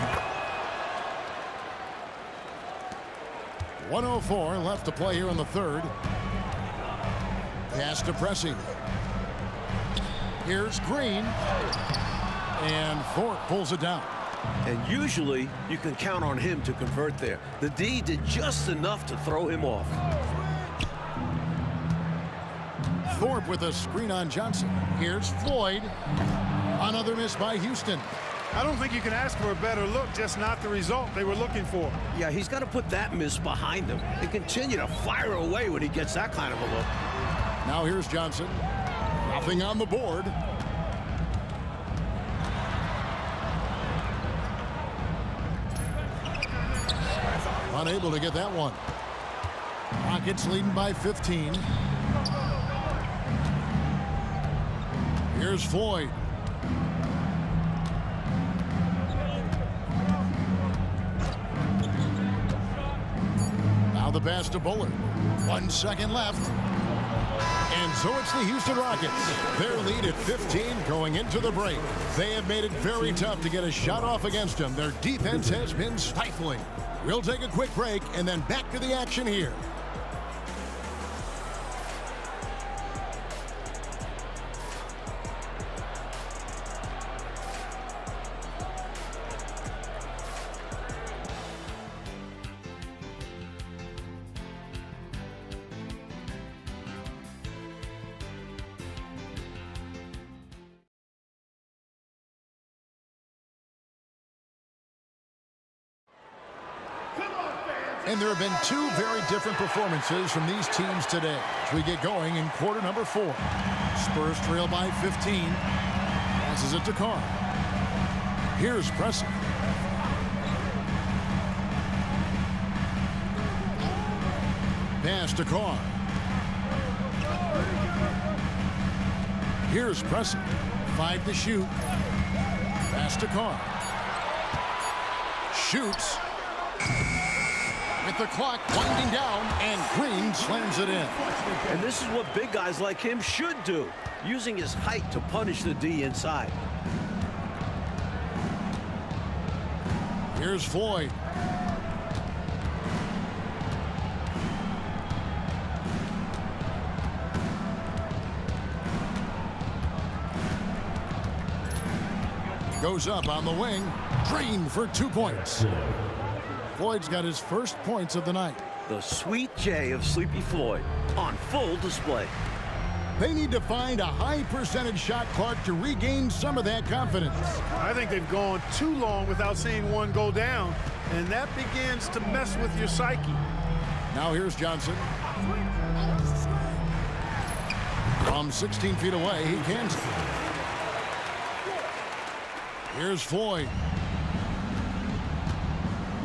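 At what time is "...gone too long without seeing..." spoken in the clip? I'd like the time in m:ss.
2:58.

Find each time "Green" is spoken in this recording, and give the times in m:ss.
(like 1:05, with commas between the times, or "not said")
0:10, 2:19, 2:44.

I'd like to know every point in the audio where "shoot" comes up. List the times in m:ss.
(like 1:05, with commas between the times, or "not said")
2:11, 2:15.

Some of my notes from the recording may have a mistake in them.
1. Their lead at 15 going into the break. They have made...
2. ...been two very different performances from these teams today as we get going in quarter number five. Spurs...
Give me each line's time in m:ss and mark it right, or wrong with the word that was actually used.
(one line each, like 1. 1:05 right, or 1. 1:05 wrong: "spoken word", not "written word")
1. 1:09 right
2. 1:48 wrong: "four", not "five".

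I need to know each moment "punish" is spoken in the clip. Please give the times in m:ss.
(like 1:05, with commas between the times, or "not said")
2:25.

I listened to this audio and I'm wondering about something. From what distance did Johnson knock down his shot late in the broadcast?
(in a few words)
16 feet.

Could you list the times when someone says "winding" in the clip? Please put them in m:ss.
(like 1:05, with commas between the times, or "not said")
2:18.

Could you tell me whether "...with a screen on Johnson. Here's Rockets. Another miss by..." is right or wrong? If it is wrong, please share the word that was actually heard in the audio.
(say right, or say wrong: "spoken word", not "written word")
wrong: "Floyd", not "Rockets".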